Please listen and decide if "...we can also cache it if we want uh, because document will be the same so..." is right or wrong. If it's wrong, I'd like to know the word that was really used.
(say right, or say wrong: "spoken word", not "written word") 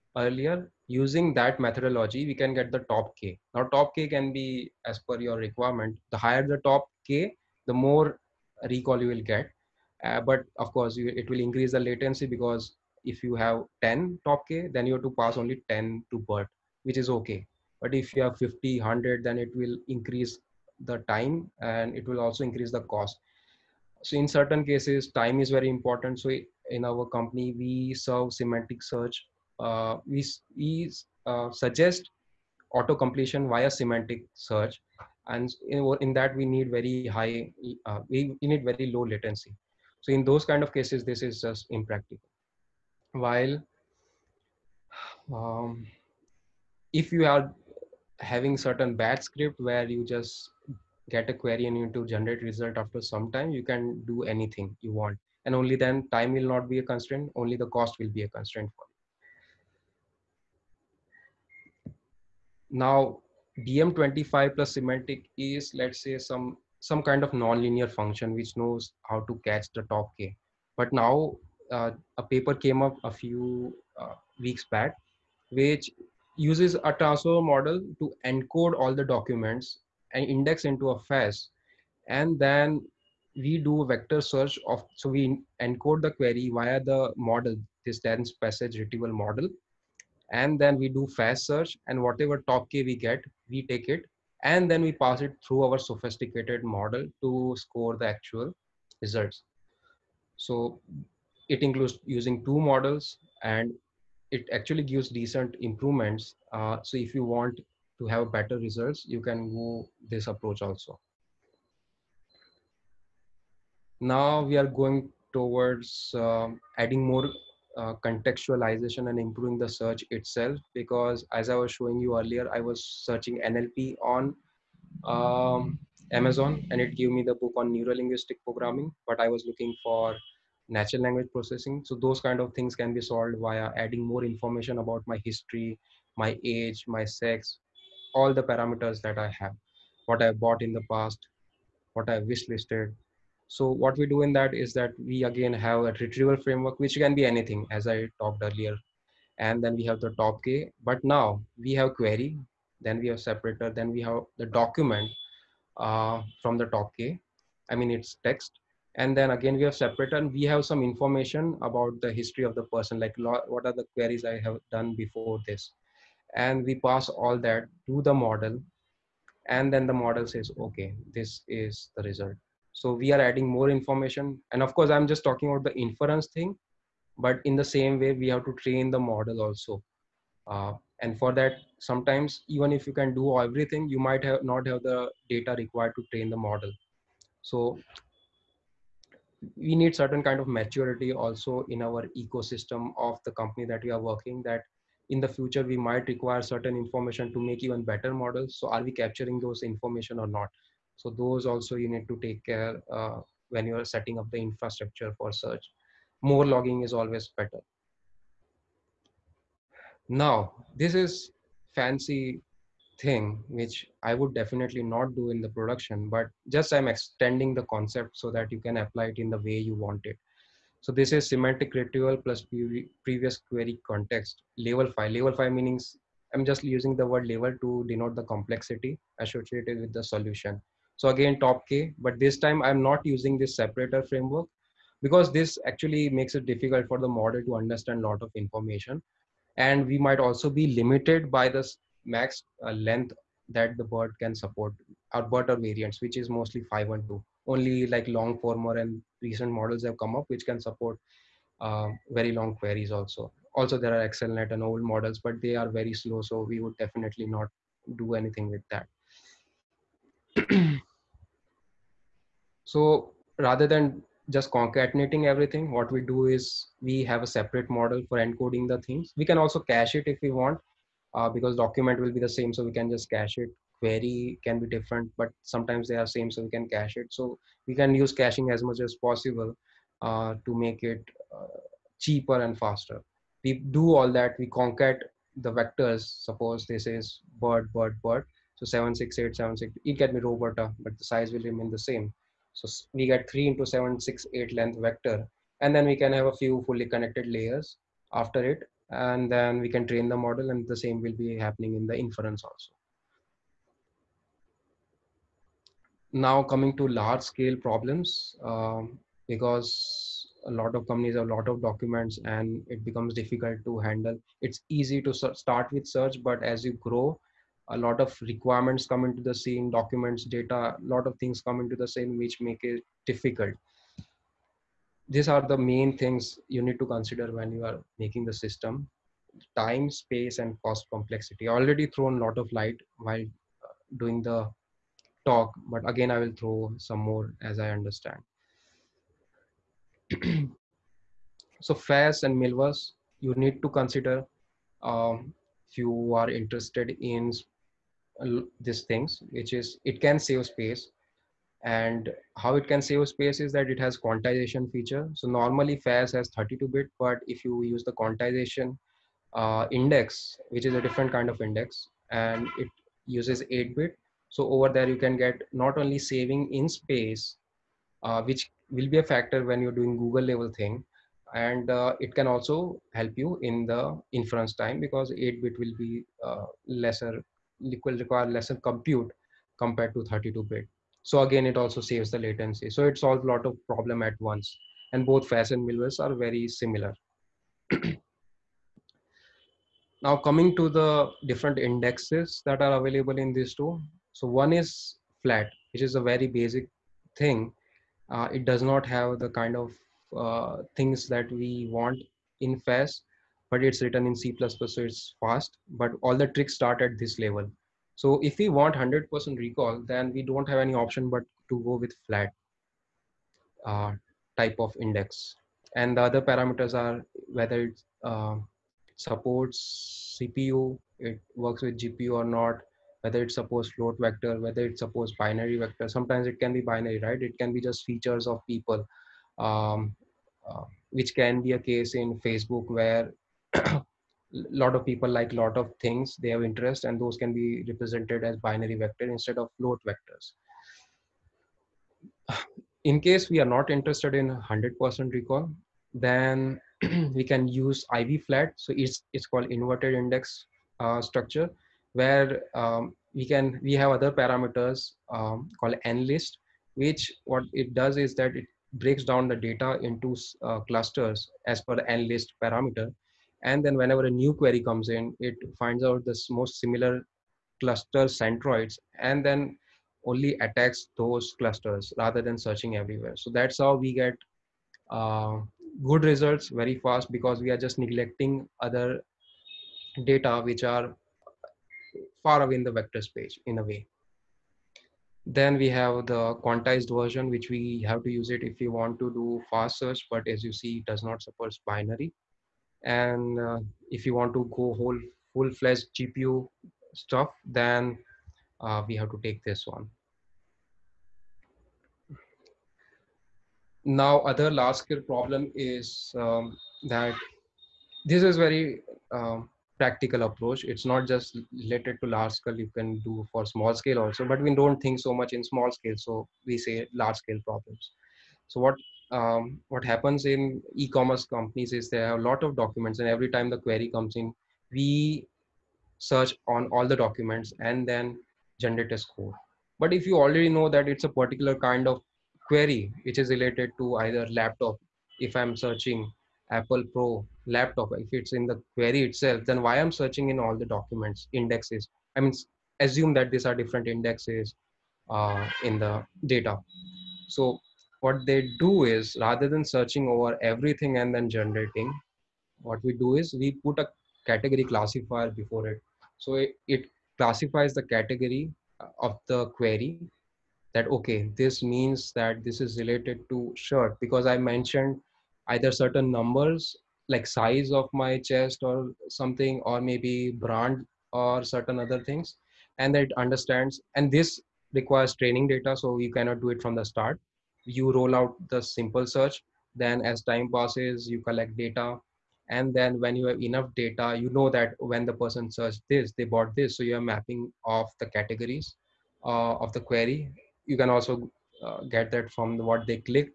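right.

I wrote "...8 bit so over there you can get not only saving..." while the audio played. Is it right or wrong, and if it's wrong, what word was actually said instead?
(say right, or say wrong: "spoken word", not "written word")
right.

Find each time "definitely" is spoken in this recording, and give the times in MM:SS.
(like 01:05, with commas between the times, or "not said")
03:34, 04:16.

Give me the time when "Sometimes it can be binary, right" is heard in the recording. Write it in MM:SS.
07:05.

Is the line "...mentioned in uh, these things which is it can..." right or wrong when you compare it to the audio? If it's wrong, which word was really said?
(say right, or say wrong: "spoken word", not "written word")
wrong: "interested", not "mentioned".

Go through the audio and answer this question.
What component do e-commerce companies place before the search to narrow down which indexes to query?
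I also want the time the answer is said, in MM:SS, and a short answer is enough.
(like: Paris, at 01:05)
Category classifier, at 09:14.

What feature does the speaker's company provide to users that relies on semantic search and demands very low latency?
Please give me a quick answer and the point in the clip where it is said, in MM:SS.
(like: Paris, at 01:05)
Auto completion, at 00:32.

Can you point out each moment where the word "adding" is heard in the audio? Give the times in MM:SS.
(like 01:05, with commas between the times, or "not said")
01:56, 02:13, 02:53.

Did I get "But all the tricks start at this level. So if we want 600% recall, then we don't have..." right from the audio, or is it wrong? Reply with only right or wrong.
wrong.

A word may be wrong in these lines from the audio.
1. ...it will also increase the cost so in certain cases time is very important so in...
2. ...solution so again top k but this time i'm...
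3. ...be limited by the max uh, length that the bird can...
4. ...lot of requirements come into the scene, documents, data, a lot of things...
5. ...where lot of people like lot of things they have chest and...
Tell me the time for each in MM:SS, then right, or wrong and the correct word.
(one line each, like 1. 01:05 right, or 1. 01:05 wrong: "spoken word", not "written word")
1. 00:21 right
2. 03:50 right
3. 04:00 right
4. 05:17 right
5. 07:12 wrong: "interest", not "chest".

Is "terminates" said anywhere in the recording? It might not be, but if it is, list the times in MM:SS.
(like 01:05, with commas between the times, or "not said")
not said.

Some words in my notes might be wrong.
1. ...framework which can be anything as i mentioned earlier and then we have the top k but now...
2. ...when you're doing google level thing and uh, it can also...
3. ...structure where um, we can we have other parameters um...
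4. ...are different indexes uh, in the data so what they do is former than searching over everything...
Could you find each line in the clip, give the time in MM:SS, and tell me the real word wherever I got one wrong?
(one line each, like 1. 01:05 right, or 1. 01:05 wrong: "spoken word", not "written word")
1. 02:26 wrong: "talked", not "mentioned"
2. 06:09 right
3. 07:31 right
4. 09:03 wrong: "rather", not "former".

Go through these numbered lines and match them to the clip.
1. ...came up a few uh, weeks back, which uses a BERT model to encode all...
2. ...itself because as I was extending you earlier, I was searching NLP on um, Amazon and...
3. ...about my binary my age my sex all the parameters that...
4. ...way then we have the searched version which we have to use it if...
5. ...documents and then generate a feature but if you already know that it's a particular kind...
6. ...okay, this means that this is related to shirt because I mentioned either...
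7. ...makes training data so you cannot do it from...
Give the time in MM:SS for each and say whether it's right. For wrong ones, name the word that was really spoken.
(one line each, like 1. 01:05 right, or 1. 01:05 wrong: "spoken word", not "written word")
1. 01:12 wrong: "Tasso", not "BERT"
2. 02:00 wrong: "showing", not "extending"
3. 02:14 wrong: "history", not "binary"
4. 08:03 wrong: "quantized", not "searched"
5. 08:46 wrong: "score", not "feature"
6. 09:20 right
7. 09:34 wrong: "requires", not "makes".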